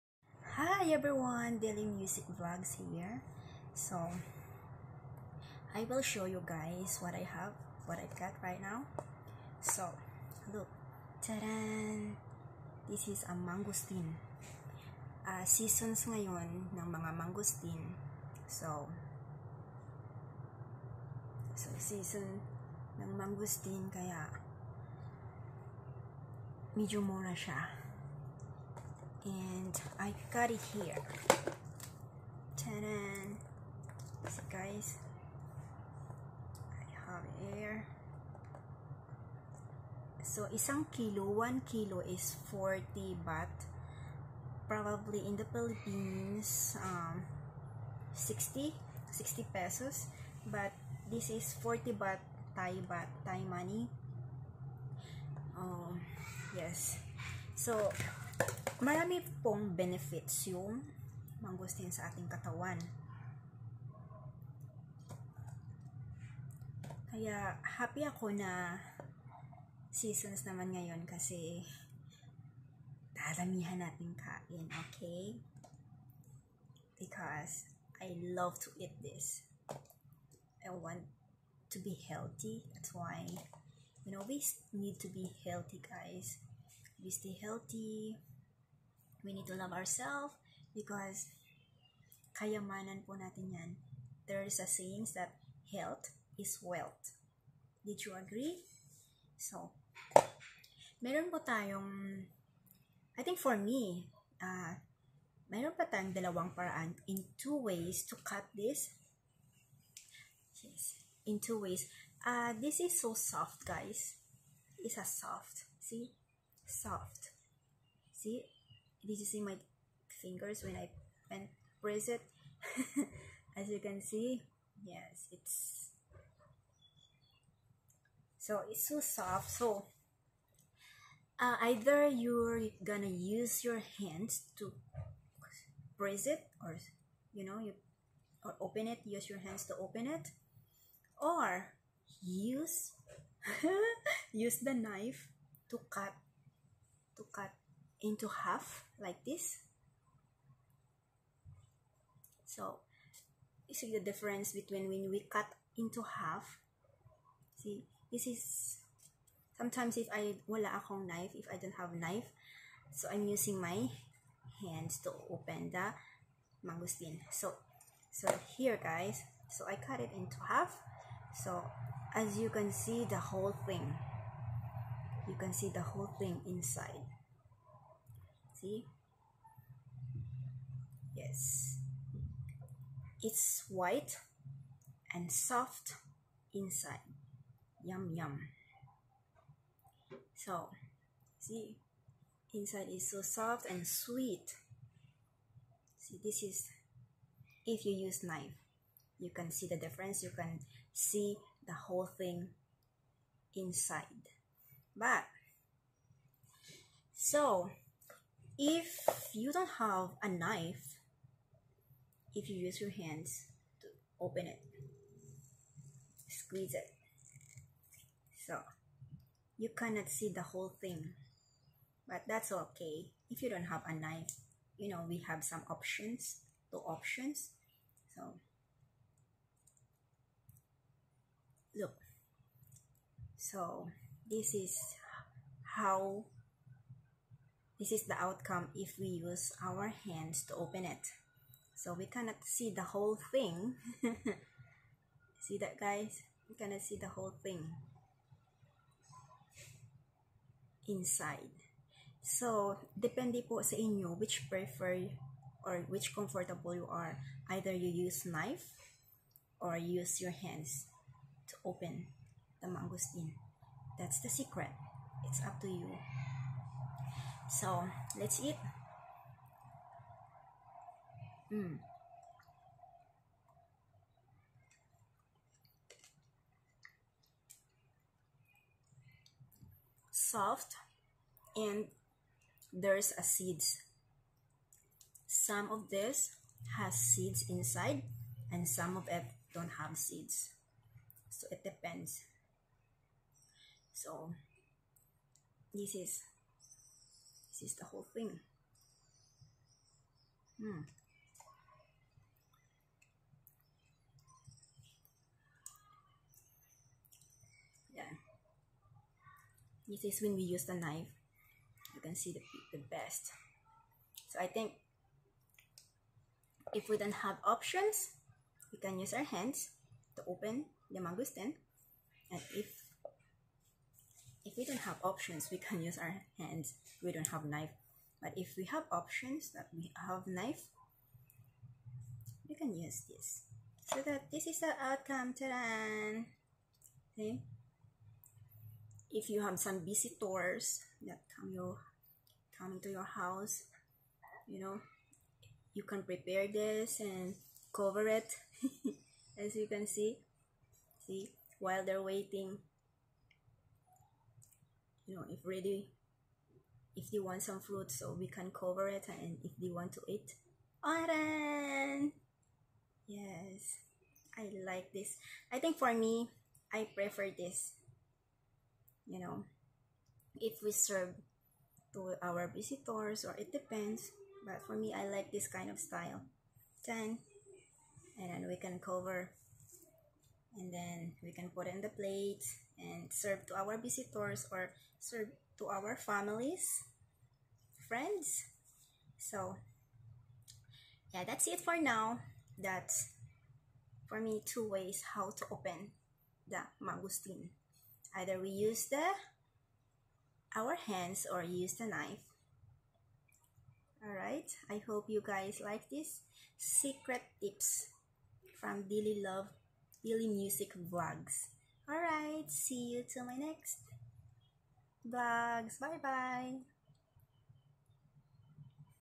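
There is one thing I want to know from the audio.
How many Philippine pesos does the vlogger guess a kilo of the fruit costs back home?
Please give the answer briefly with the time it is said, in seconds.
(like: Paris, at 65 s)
60 pesos, at 49 s.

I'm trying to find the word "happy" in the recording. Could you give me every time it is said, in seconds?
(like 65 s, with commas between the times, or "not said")
67 s.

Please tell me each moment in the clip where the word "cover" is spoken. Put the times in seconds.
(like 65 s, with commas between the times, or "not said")
347 s, 358 s, 378 s.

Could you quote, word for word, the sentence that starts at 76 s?
Because I love to eat this.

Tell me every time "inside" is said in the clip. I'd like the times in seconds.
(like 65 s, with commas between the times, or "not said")
176 s, 186 s, 192 s, 203 s, 250 s, 287 s.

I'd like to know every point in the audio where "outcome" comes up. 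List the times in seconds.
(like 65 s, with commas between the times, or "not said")
238 s, 334 s.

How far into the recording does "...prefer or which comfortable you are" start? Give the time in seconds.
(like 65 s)
254 s.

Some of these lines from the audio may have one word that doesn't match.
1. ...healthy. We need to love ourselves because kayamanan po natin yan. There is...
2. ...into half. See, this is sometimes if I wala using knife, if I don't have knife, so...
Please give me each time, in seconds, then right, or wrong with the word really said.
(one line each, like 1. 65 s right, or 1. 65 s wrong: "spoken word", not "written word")
1. 87 s right
2. 155 s wrong: "akong", not "using".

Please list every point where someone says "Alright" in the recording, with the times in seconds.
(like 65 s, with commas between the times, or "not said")
411 s.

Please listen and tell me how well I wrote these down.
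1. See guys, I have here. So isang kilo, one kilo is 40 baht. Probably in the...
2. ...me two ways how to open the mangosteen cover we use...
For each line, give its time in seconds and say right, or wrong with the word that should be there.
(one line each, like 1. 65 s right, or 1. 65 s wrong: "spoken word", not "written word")
1. 34 s right
2. 394 s wrong: "either", not "cover".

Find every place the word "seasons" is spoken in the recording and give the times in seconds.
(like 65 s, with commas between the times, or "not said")
15 s, 21 s, 69 s.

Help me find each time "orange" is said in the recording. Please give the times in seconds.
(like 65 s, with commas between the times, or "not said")
360 s.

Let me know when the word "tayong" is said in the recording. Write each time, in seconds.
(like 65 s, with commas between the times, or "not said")
101 s, 105 s.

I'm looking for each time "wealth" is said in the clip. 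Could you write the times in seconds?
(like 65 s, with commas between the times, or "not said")
96 s.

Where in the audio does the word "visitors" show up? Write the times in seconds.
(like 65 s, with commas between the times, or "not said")
339 s, 372 s, 383 s.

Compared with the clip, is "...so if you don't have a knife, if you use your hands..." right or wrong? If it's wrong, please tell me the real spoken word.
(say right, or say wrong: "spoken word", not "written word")
right.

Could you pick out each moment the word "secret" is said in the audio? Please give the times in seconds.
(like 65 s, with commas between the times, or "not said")
264 s, 406 s.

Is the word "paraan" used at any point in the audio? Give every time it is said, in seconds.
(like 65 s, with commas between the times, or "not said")
106 s.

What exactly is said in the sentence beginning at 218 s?
So you cannot see the whole thing, but that's okay.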